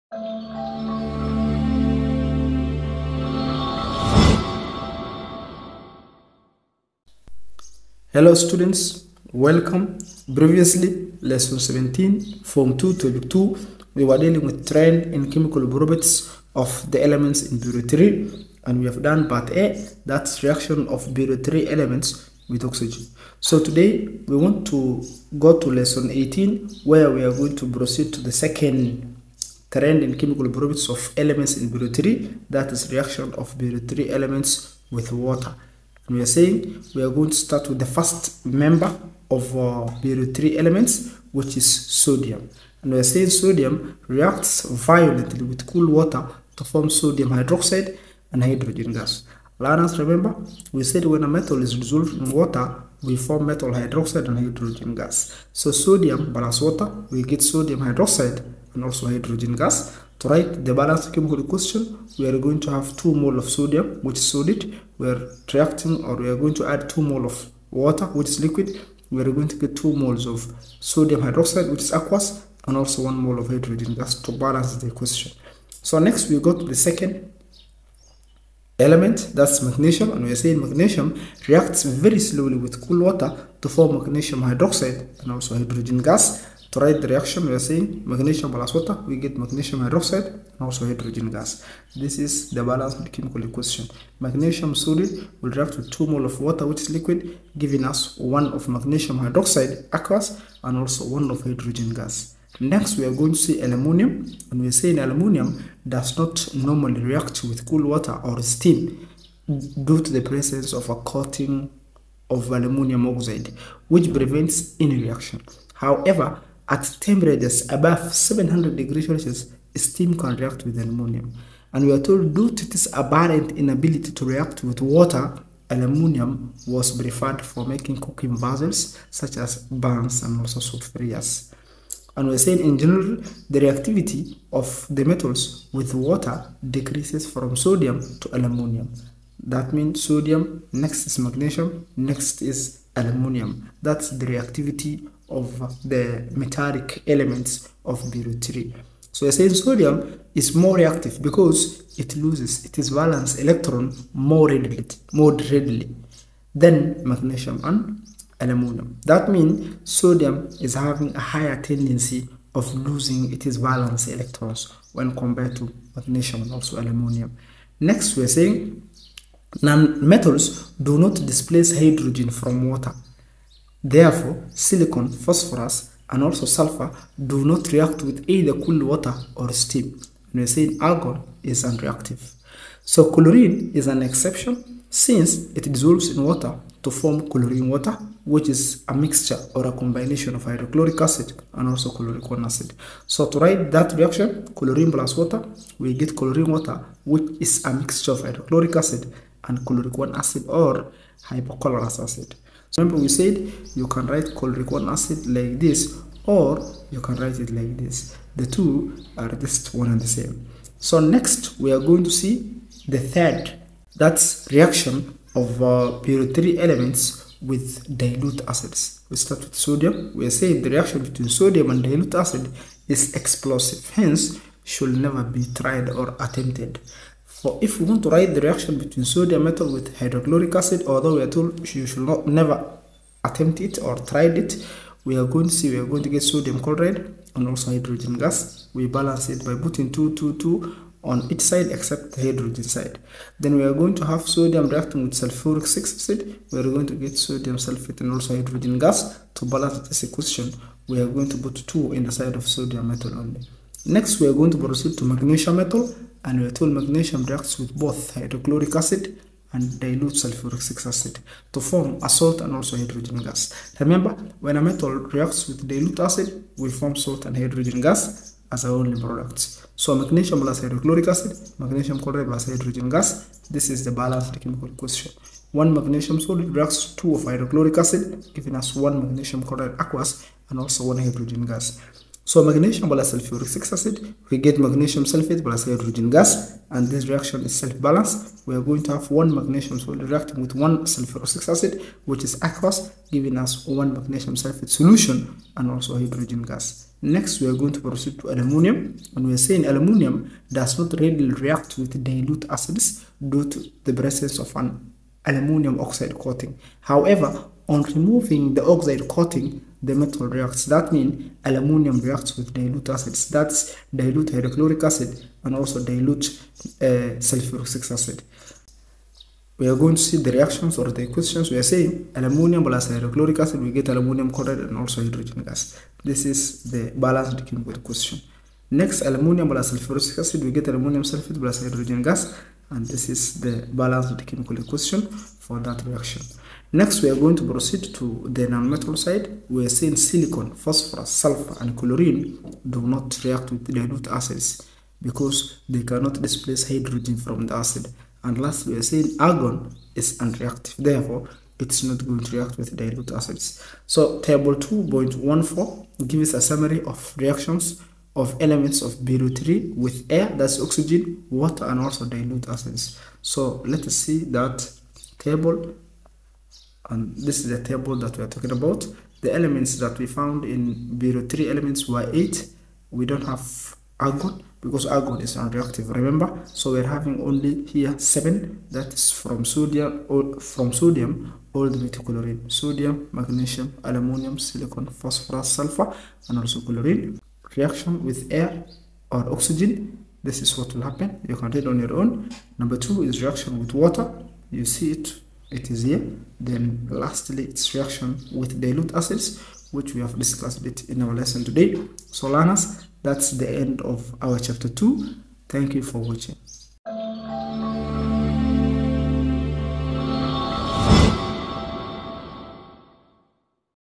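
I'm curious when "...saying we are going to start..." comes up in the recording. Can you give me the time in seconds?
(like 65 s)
36 s.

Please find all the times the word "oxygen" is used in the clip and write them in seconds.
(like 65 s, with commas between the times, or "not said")
22 s, 360 s, 389 s.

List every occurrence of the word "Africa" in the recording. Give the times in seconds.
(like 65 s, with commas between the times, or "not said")
not said.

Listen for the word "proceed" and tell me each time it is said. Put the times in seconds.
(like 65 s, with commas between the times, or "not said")
27 s, 254 s, 297 s, 337 s.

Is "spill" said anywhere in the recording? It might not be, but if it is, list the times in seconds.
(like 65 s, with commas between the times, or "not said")
not said.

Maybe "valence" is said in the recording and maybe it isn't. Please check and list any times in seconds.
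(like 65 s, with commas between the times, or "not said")
152 s, 163 s.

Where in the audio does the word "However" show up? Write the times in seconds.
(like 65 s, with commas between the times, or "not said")
115 s, 306 s.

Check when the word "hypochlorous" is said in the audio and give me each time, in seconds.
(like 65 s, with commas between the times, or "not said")
201 s.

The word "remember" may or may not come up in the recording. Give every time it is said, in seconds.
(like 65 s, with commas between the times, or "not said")
49 s, 202 s, 263 s, 375 s.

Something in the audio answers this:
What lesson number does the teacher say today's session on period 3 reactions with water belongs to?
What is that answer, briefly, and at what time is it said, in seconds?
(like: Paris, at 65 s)
18, at 25 s.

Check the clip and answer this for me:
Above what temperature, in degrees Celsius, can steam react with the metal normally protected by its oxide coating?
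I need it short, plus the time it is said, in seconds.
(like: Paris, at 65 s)
700, at 118 s.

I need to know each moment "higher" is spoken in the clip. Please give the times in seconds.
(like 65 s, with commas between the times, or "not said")
161 s.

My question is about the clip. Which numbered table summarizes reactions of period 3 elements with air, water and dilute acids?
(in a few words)
Table 2.14.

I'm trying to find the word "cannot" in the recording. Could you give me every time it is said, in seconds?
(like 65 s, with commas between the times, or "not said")
345 s.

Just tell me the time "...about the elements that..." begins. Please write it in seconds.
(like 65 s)
368 s.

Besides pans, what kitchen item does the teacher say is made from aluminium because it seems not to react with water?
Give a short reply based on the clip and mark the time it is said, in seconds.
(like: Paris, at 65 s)
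soup fryers, at 130 s.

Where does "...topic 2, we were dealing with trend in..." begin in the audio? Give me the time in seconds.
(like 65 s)
12 s.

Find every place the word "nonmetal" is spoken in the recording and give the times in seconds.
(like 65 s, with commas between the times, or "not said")
338 s.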